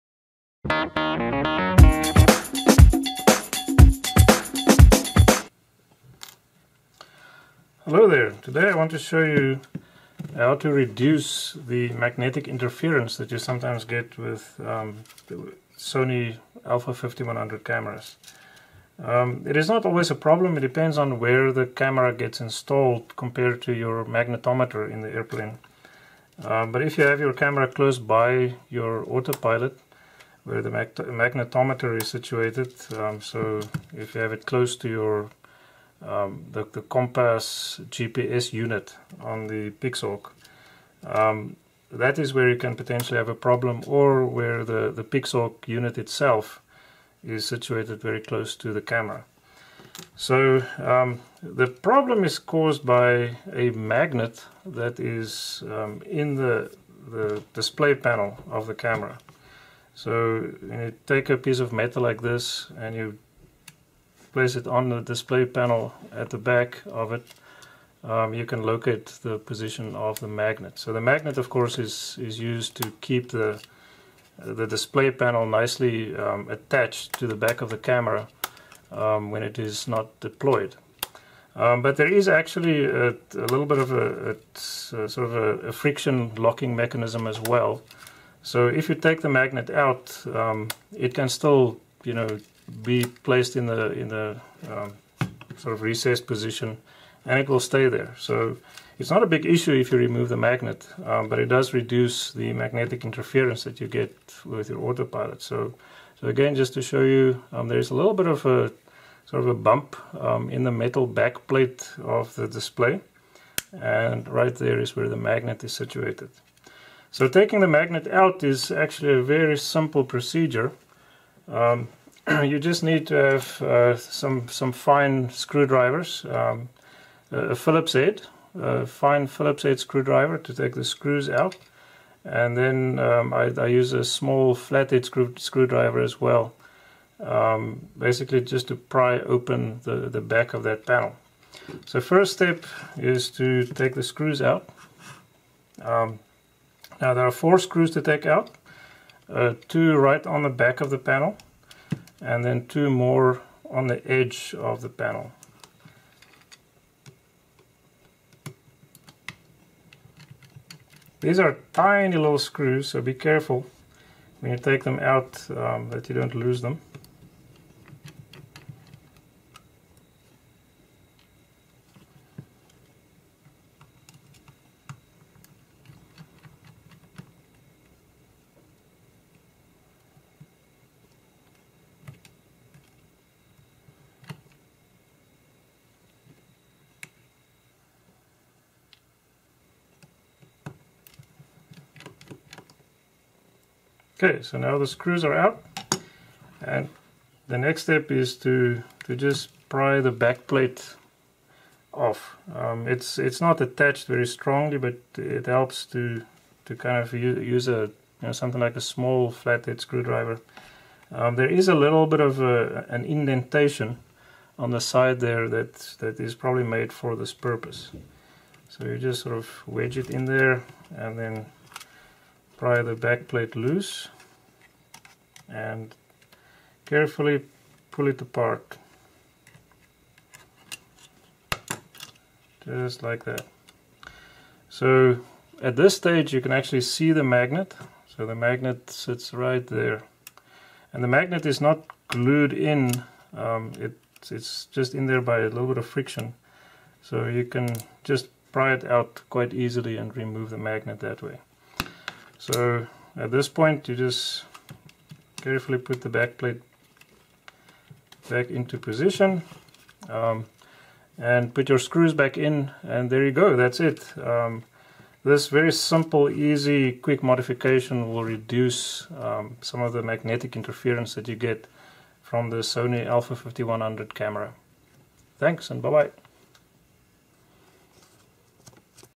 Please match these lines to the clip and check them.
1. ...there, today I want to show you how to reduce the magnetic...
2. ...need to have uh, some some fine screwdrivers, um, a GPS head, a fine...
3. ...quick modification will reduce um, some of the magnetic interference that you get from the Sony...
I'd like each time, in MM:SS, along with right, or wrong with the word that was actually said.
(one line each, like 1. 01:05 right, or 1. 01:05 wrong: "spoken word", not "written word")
1. 00:08 right
2. 02:02 wrong: "Phillips", not "GPS"
3. 04:26 right.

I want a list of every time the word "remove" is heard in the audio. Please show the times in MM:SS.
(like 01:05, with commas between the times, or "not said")
01:39, 04:10.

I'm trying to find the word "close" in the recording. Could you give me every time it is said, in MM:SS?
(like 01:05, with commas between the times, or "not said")
00:27, 00:34, 00:48.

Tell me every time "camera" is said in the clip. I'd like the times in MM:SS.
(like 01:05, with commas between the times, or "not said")
00:17, 00:21, 00:27, 00:48, 00:58, 01:17, 04:34.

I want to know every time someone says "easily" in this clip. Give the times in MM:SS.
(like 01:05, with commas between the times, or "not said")
04:09.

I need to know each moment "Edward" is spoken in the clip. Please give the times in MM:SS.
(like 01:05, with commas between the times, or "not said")
not said.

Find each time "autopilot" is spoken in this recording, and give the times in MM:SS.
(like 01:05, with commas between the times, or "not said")
00:29, 01:44.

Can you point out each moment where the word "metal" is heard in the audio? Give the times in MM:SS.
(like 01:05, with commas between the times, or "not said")
01:01, 01:50.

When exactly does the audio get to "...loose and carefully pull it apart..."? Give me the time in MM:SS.
03:43.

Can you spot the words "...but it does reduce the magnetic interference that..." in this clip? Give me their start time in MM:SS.
01:41.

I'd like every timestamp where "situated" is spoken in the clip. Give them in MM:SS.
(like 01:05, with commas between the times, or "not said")
00:32, 00:47, 01:55.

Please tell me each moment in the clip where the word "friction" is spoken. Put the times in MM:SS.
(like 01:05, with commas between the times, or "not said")
01:25, 04:05.